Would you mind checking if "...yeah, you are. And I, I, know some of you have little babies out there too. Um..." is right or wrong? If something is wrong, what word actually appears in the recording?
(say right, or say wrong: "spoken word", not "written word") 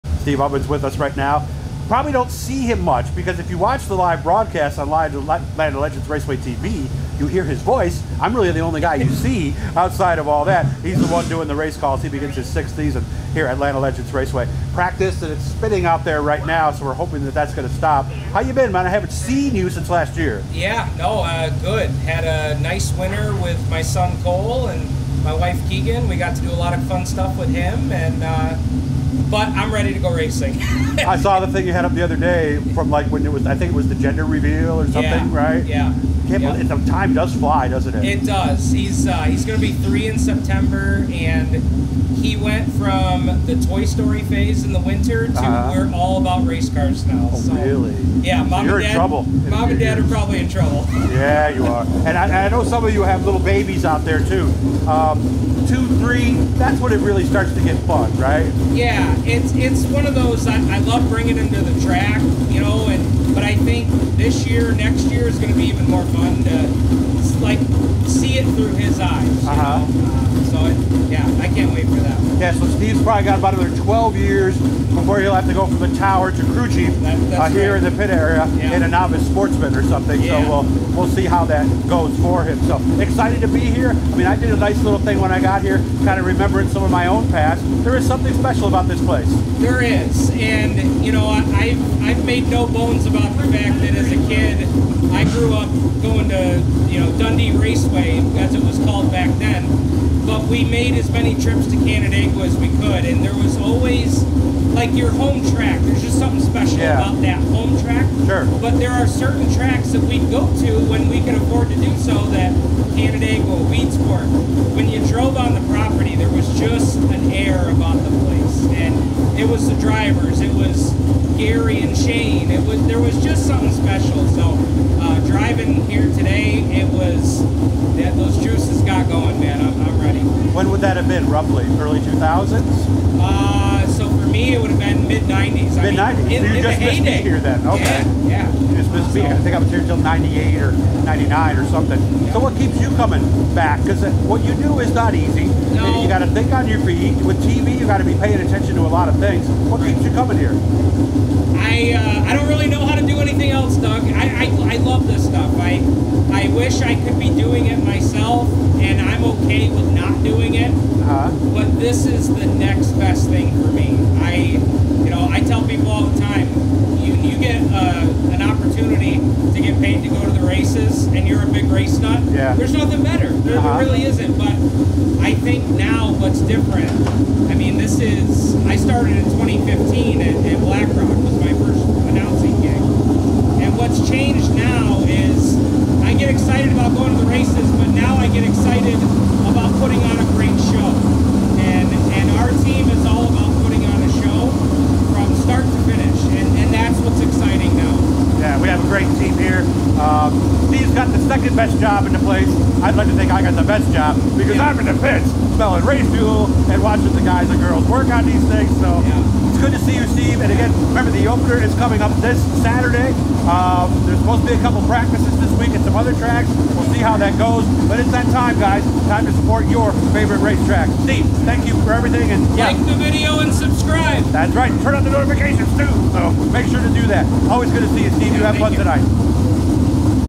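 right.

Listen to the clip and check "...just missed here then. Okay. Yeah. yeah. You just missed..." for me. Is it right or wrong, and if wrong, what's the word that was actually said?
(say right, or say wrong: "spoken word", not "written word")
right.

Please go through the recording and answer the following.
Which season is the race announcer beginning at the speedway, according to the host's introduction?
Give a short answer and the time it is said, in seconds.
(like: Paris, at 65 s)
sixth, at 12 s.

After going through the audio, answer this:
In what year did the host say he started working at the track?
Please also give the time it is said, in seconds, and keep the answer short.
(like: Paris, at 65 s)
2015, at 179 s.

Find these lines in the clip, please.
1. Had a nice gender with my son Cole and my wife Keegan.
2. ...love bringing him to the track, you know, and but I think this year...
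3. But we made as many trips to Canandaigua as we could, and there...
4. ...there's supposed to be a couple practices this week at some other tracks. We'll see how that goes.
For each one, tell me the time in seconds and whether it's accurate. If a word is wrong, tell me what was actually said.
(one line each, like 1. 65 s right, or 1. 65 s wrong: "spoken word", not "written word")
1. 22 s wrong: "winter", not "gender"
2. 60 s right
3. 100 s right
4. 214 s right.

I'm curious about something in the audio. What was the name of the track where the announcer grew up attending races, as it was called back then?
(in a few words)
Dundee Raceway.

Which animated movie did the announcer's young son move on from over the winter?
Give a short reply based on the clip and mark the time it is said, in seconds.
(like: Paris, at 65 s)
Toy Story, at 43 s.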